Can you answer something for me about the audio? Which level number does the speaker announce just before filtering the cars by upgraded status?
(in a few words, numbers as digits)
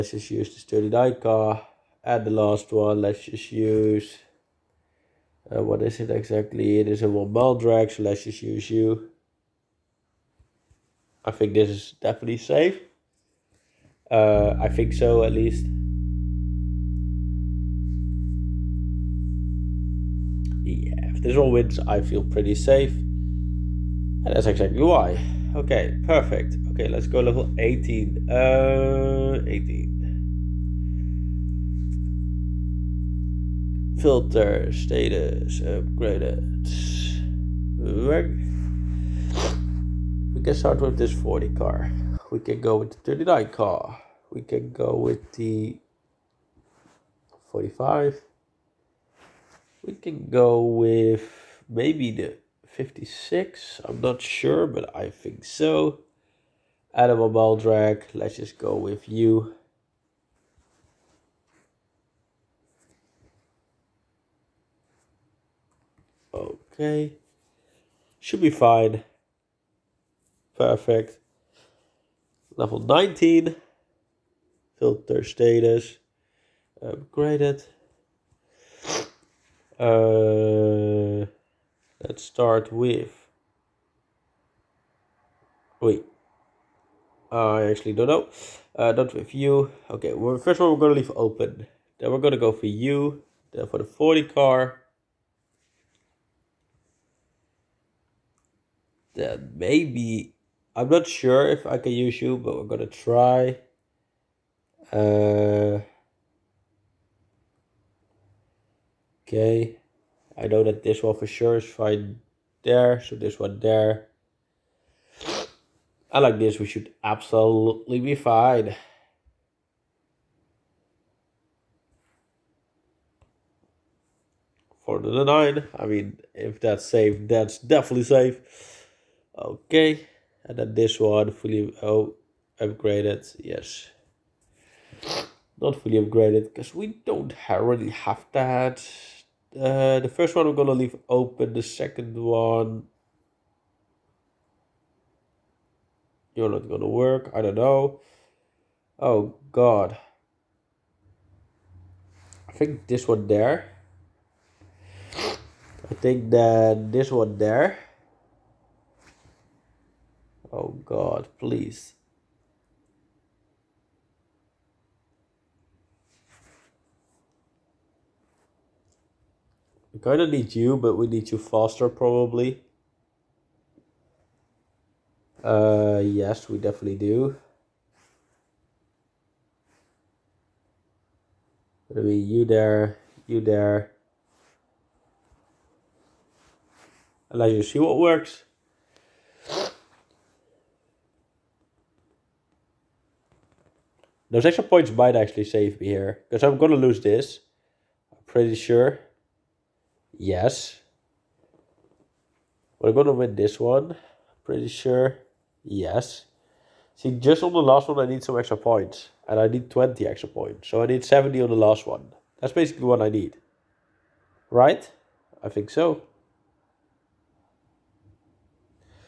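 19.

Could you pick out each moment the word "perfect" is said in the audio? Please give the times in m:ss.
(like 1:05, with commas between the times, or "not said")
0:26, 1:10.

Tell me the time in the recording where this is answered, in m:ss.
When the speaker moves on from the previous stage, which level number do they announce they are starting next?
0:27.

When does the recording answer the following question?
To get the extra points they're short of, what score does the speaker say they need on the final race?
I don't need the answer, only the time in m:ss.
3:31.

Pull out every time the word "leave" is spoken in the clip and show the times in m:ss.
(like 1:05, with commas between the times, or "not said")
1:31, 2:20.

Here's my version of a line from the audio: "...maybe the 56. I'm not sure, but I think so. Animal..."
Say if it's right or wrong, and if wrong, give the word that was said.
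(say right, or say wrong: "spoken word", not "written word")
right.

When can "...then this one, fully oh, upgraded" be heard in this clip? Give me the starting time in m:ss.
2:10.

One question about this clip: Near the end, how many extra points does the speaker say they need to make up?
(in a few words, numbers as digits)
20.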